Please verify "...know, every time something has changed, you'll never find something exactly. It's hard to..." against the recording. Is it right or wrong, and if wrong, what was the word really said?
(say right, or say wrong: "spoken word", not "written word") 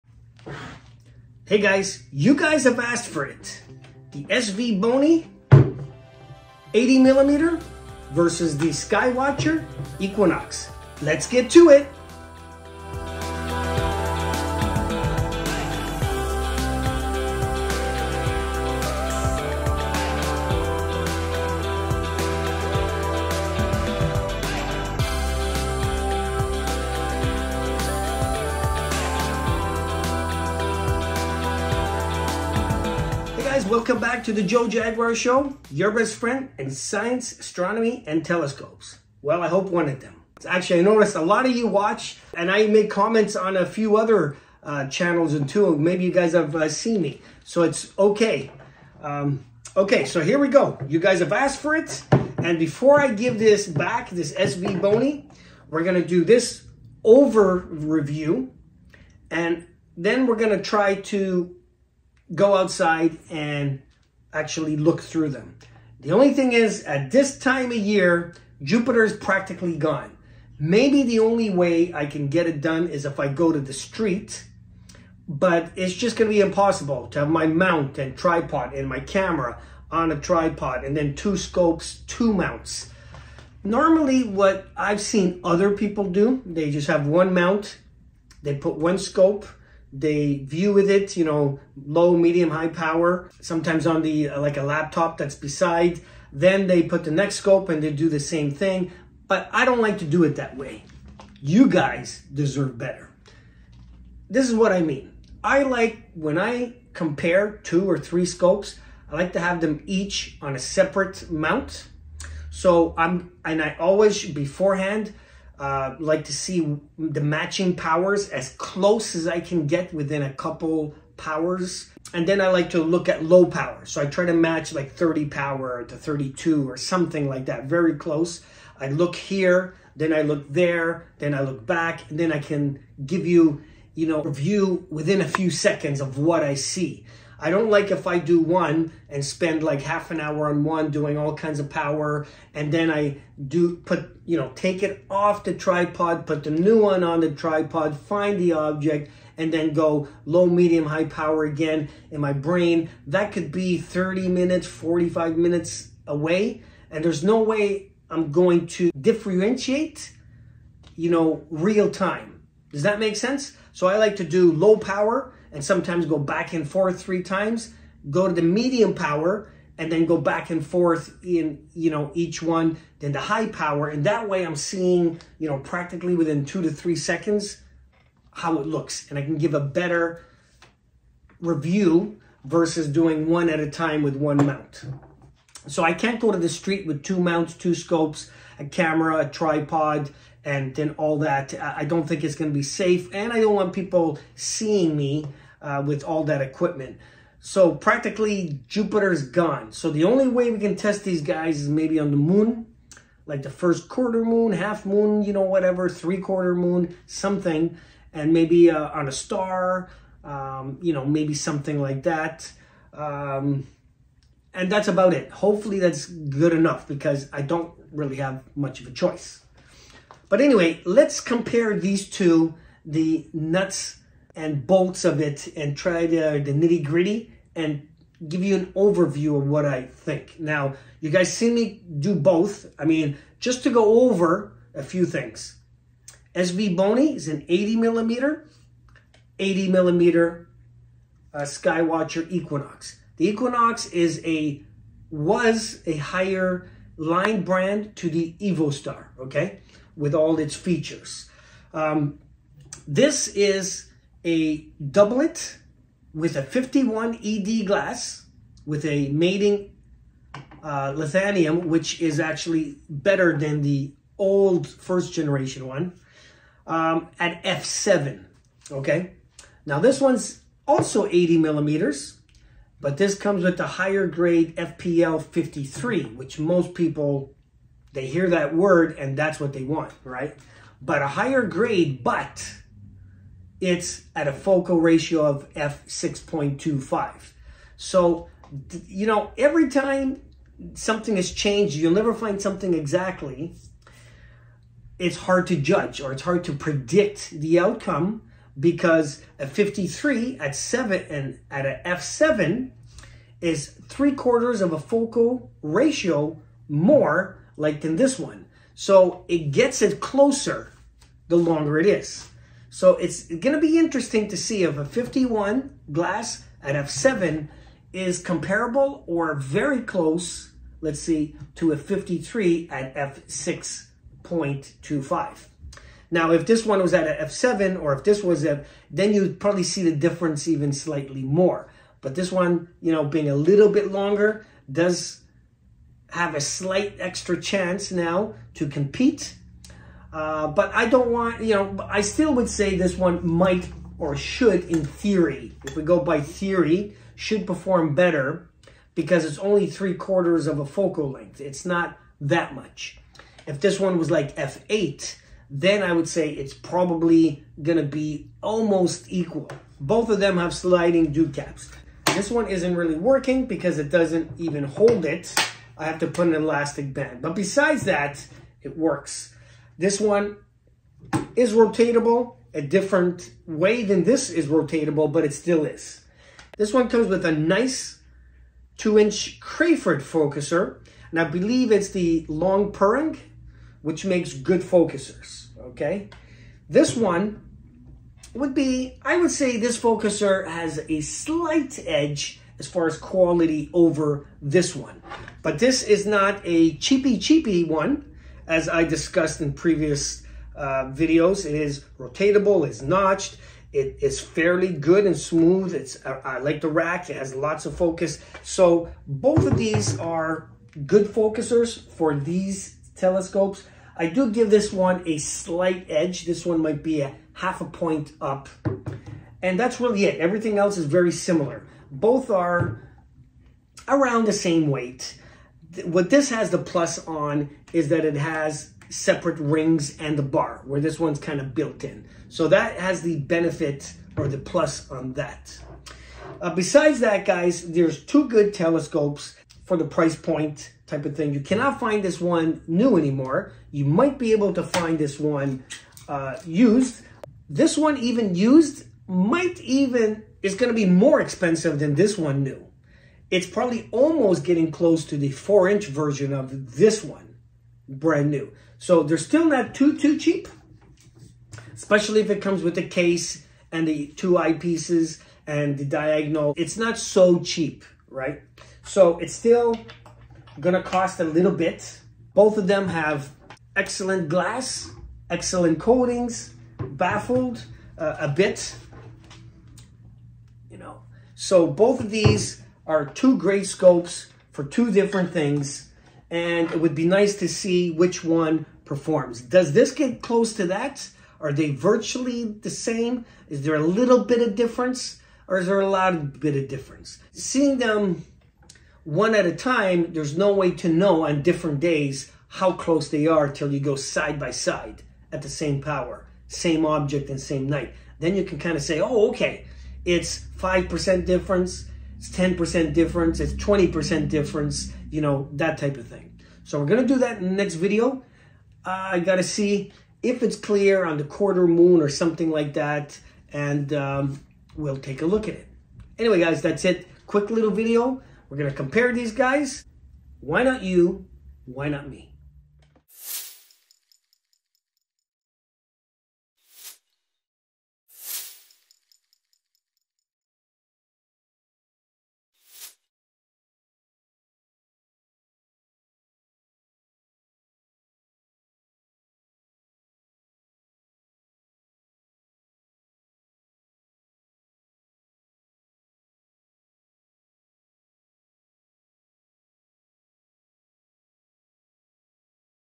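right.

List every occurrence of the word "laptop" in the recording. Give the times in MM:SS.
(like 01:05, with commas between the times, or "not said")
01:34.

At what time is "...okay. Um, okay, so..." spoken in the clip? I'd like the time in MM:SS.
00:47.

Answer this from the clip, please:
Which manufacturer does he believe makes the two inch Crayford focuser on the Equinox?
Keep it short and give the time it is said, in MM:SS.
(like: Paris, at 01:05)
Long Perng, at 06:22.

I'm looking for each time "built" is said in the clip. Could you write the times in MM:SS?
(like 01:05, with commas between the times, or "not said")
07:11.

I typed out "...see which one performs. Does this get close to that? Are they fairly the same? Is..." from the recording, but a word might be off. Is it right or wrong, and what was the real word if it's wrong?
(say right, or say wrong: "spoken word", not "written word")
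wrong: "virtually", not "fairly".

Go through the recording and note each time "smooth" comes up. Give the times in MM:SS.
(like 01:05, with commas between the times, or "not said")
06:45.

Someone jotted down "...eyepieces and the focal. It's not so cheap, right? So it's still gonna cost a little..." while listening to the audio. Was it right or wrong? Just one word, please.
wrong.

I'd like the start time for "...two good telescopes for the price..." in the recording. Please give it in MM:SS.
07:18.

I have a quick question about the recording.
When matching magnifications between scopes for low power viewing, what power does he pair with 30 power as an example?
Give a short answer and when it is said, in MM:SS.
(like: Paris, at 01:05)
32, at 02:05.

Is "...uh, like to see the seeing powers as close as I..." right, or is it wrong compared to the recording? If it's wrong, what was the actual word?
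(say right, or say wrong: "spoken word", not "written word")
wrong: "matching", not "seeing".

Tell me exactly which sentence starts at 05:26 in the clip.
Now, if this one was at f7 or if this was a, then you'd probably see the difference even slightly more.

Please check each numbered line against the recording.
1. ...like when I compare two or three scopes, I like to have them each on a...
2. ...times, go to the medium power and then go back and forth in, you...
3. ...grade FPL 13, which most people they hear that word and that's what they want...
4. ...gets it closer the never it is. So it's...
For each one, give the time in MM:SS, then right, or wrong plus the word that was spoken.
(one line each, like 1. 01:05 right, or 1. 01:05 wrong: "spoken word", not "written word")
1. 01:45 right
2. 02:47 right
3. 04:34 wrong: "53", not "13"
4. 05:09 wrong: "longer", not "never".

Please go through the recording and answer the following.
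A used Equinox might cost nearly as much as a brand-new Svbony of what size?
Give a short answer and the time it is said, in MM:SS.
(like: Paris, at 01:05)
four inch, at 07:35.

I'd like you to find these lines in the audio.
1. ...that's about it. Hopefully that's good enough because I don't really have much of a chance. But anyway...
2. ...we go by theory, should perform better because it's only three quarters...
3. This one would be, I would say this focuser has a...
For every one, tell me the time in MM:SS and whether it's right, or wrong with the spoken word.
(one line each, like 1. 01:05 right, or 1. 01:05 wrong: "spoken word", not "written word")
1. 03:34 wrong: "choice", not "chance"
2. 05:45 right
3. 06:26 right.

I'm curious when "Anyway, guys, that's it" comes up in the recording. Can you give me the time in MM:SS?
08:46.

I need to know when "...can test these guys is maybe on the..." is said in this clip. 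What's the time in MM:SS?
03:20.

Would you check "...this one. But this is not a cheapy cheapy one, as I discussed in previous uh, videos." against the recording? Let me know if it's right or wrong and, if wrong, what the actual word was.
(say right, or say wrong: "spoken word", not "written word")
right.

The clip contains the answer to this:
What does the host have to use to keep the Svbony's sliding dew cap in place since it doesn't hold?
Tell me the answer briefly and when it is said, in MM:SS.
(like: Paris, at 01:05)
elastic band, at 06:06.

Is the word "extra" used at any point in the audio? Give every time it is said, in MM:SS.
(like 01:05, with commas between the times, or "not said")
05:36.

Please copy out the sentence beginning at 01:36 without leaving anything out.
Then they put the next scope and they do the same thing.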